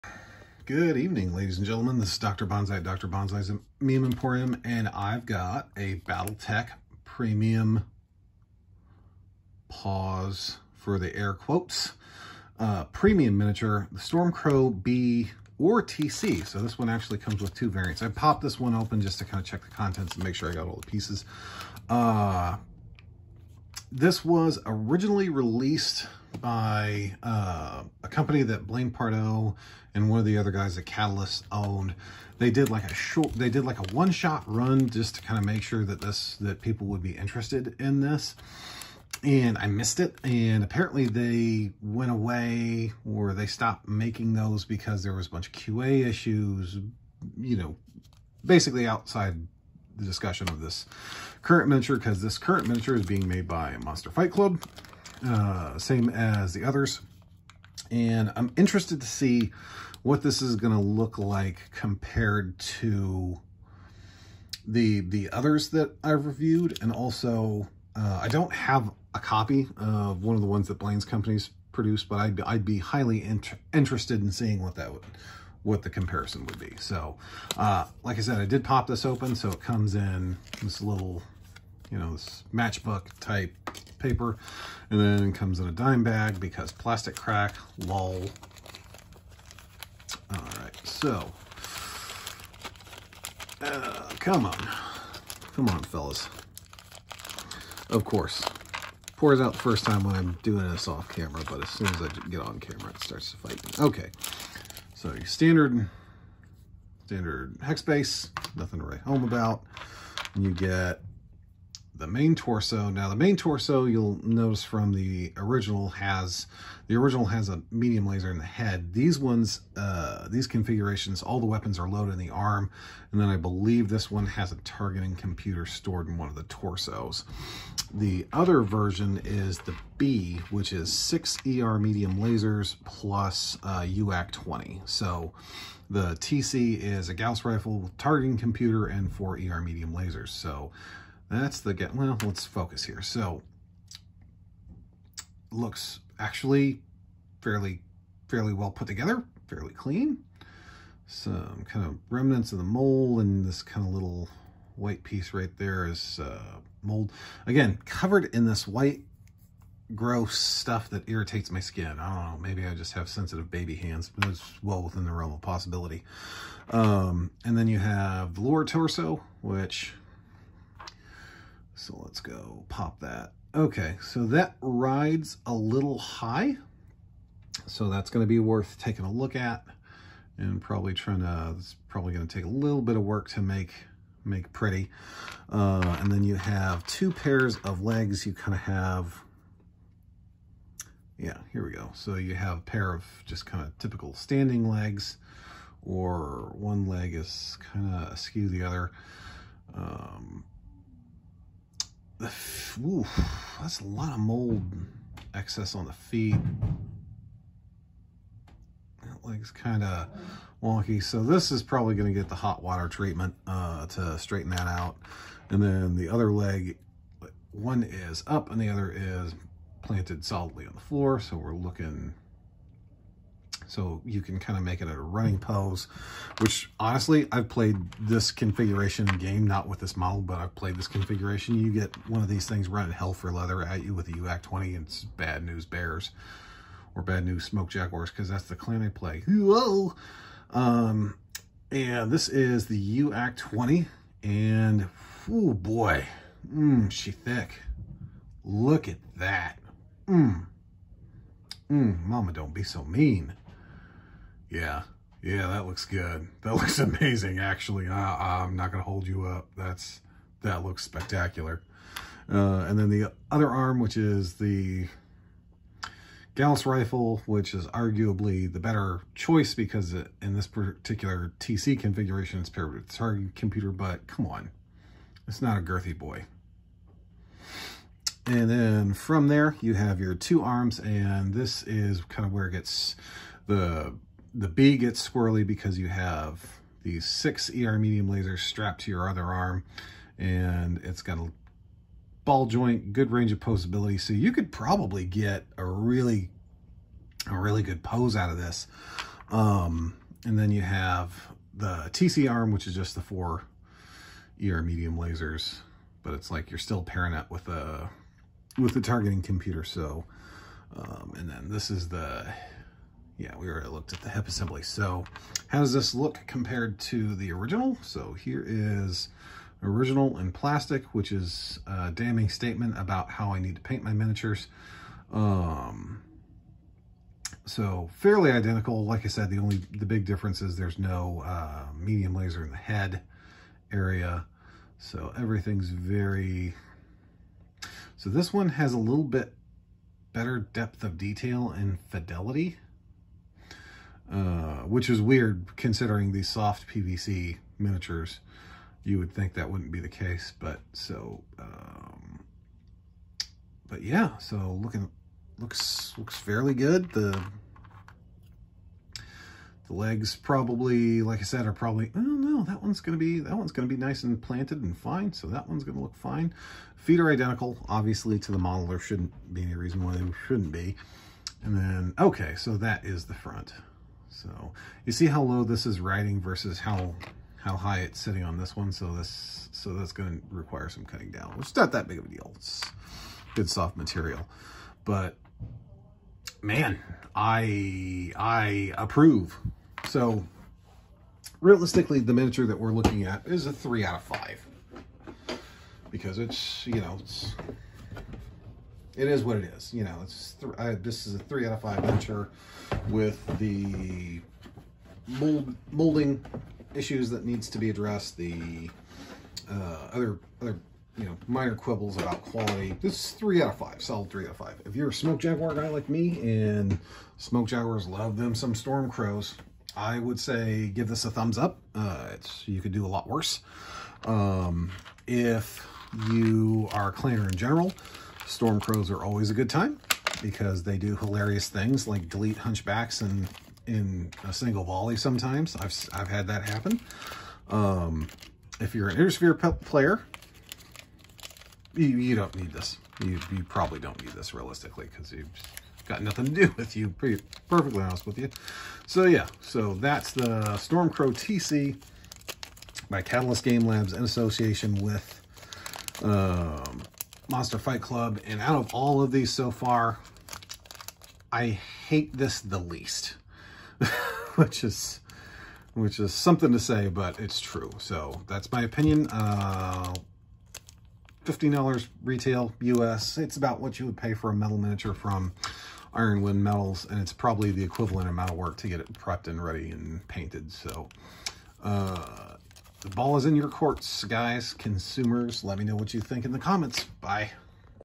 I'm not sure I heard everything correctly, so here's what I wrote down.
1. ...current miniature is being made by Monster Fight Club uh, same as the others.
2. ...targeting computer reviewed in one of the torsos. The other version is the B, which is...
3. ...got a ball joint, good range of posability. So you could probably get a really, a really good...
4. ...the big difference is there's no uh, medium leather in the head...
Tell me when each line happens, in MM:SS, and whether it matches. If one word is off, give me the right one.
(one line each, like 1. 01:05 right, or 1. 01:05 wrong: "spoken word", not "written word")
1. 00:52 right
2. 02:04 wrong: "stored", not "reviewed"
3. 04:51 right
4. 05:29 wrong: "laser", not "leather".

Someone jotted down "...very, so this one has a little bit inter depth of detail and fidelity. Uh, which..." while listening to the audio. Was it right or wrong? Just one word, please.
wrong.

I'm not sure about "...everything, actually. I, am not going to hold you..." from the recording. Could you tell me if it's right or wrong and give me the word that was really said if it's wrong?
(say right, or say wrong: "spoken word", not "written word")
wrong: "amazing", not "everything".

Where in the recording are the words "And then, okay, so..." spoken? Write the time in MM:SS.
06:11.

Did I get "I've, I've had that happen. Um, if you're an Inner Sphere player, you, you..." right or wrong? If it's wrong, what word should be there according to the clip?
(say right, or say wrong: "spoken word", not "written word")
right.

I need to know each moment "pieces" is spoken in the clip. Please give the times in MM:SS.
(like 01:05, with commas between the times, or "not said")
00:20, 02:35.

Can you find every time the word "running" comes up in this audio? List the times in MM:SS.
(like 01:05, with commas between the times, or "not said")
03:44, 03:52.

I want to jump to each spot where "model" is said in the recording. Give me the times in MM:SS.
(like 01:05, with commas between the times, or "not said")
03:49, 06:08.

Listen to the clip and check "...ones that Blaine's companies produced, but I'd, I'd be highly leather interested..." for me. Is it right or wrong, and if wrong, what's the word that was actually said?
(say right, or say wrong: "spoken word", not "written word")
wrong: "inter", not "leather".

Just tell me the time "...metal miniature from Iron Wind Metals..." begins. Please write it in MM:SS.
07:54.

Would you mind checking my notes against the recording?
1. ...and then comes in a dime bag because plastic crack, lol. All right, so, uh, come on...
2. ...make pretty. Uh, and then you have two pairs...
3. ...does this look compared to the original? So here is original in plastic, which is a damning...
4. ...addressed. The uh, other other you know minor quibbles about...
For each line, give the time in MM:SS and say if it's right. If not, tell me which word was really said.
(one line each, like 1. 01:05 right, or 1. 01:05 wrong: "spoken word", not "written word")
1. 01:24 right
2. 03:04 right
3. 05:15 right
4. 06:47 right.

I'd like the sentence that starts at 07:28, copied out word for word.
So yeah, so that's the Stormcrow TC by Catalyst Game Labs in association with um, Monster Fight Club.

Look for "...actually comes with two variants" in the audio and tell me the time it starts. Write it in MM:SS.
00:16.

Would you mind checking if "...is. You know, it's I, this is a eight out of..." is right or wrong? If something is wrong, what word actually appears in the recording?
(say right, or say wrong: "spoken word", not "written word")
wrong: "three", not "eight".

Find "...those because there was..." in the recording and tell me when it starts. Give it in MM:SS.
00:44.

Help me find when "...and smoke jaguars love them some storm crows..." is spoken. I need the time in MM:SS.
06:56.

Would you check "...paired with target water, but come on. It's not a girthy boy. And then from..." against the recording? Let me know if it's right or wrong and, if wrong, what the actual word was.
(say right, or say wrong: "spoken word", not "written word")
wrong: "computer", not "water".